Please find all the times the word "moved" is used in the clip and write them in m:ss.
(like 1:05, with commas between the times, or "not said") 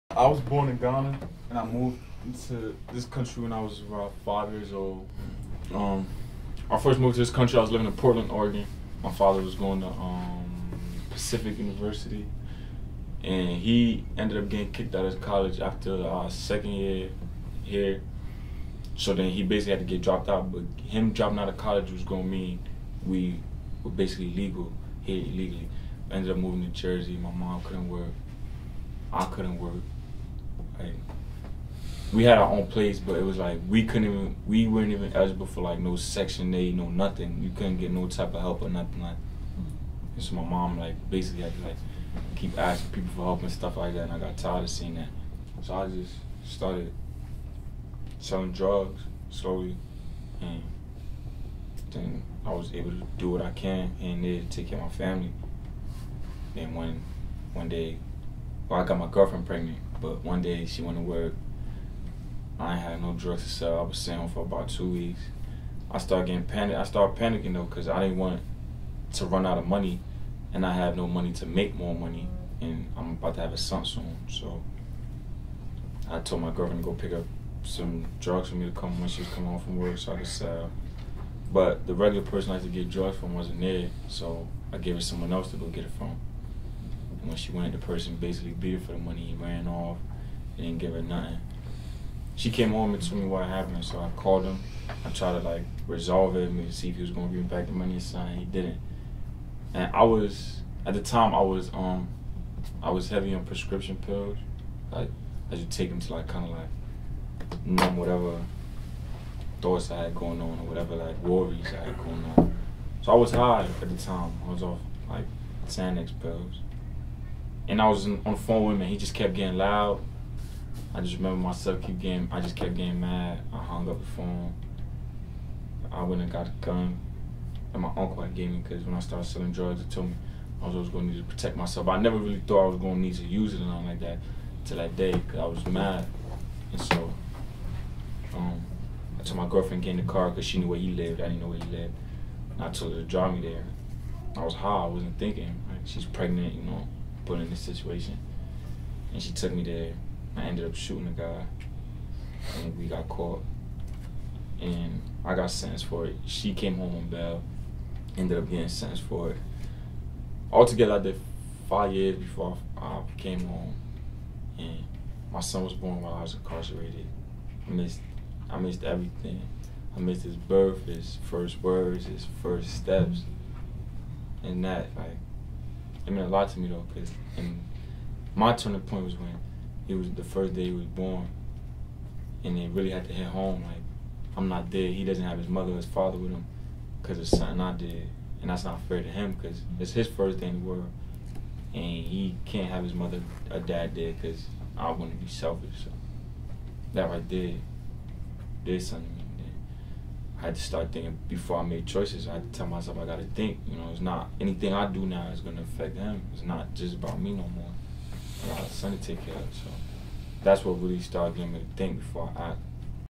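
0:01, 0:06.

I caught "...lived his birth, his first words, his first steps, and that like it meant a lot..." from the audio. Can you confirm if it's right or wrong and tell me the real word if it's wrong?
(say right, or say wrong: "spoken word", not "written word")
wrong: "missed", not "lived".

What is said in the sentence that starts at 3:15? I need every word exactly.
So that right there did something I had to start thinking before I made choices.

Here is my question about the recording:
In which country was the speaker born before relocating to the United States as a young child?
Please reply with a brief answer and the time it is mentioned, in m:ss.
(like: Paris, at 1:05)
Ghana, at 0:00.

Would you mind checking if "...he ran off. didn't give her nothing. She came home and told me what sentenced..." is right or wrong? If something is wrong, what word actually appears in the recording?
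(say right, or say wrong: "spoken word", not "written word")
wrong: "happened", not "sentenced".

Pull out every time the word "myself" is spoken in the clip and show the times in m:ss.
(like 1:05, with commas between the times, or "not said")
2:01, 2:11, 3:22.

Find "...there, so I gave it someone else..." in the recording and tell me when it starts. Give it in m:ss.
1:23.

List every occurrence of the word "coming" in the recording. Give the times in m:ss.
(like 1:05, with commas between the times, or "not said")
1:19.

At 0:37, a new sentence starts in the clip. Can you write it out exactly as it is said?
You couldn't get no type of help or nothing like.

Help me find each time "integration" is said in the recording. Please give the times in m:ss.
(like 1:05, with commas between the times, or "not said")
not said.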